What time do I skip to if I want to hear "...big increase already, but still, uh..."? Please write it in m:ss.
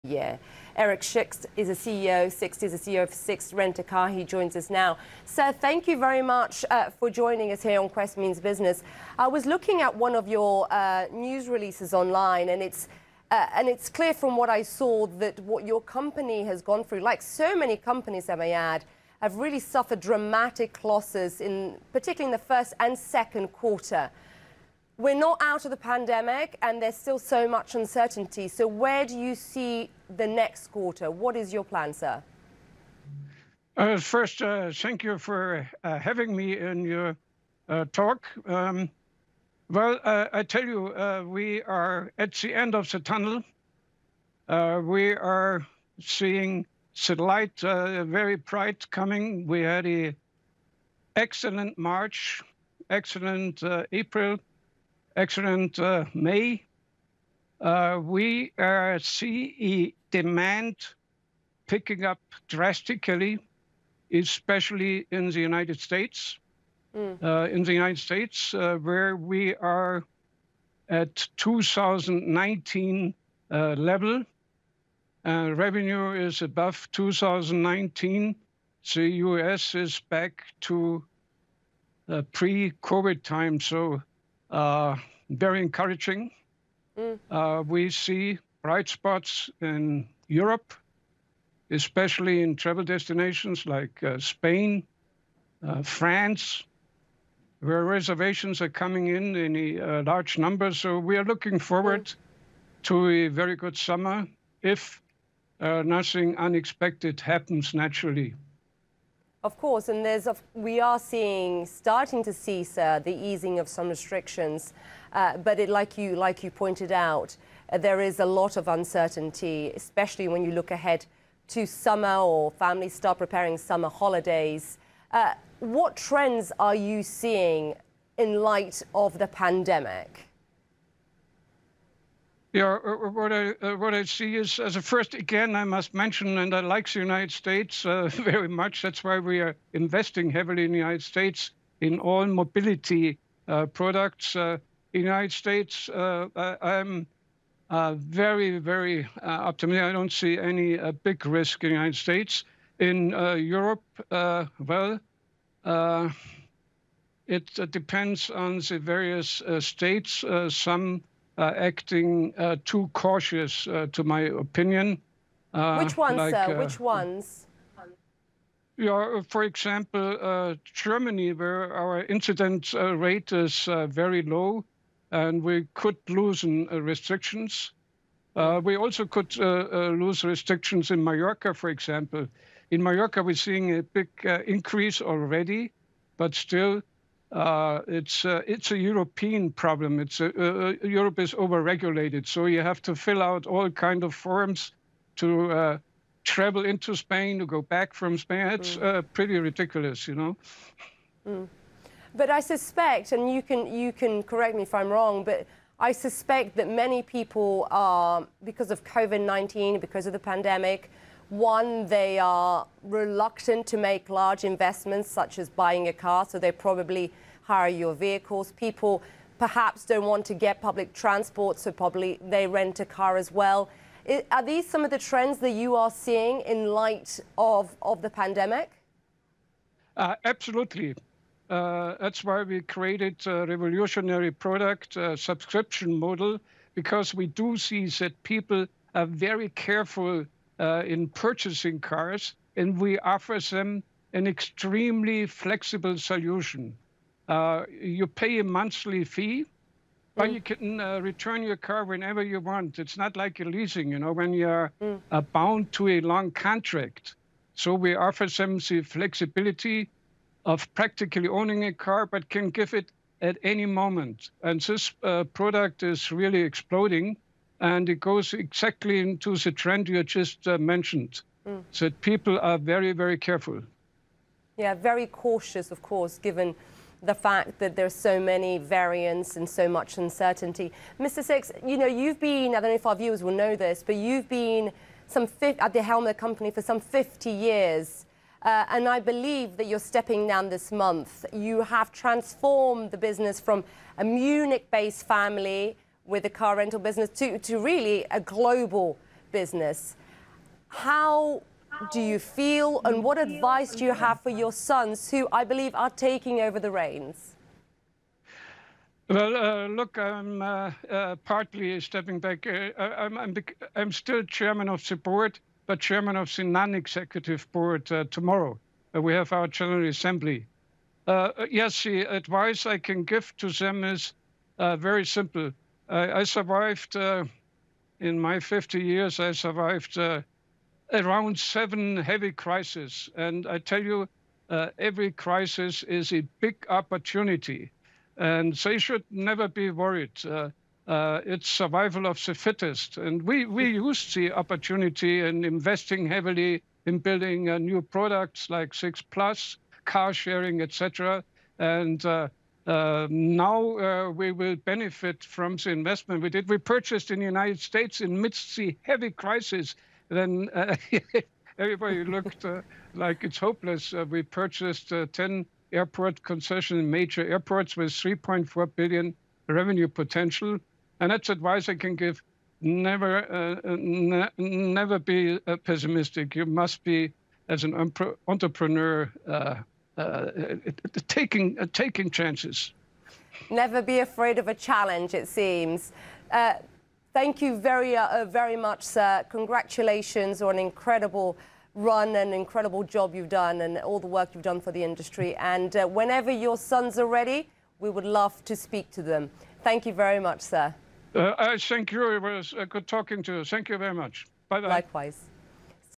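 3:03.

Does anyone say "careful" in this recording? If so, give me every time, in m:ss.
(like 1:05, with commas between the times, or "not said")
3:59, 4:33.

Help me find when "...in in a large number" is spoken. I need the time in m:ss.
1:39.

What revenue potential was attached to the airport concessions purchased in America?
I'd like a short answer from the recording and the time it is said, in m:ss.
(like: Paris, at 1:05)
3.4 billion, at 6:07.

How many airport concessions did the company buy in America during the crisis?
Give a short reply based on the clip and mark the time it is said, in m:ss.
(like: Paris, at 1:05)
10, at 6:05.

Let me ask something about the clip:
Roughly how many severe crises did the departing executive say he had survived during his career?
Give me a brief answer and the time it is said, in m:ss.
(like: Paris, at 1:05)
7, at 5:31.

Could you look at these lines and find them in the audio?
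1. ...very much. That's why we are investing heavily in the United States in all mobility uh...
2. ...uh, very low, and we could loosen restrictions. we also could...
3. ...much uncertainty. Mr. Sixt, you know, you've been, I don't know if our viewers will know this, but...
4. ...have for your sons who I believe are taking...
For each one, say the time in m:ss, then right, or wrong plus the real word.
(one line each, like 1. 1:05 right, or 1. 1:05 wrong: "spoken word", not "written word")
1. 2:18 right
2. 2:53 right
3. 4:39 right
4. 5:03 right.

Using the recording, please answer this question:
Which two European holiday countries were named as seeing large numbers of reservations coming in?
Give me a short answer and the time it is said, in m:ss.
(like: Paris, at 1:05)
Spain, France, at 1:34.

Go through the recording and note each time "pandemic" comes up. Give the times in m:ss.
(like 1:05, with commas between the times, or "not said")
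0:25, 2:09, 3:30, 3:48.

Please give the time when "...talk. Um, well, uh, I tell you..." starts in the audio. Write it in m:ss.
0:37.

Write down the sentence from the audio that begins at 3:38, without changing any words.
People perhaps don't want to get public transport, so probably they rent a car as well.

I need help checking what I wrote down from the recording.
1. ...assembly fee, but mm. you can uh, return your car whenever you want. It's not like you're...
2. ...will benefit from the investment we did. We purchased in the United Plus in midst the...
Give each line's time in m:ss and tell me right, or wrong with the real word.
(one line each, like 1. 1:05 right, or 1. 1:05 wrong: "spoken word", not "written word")
1. 4:08 wrong: "monthly", not "assembly"
2. 5:54 wrong: "States", not "Plus".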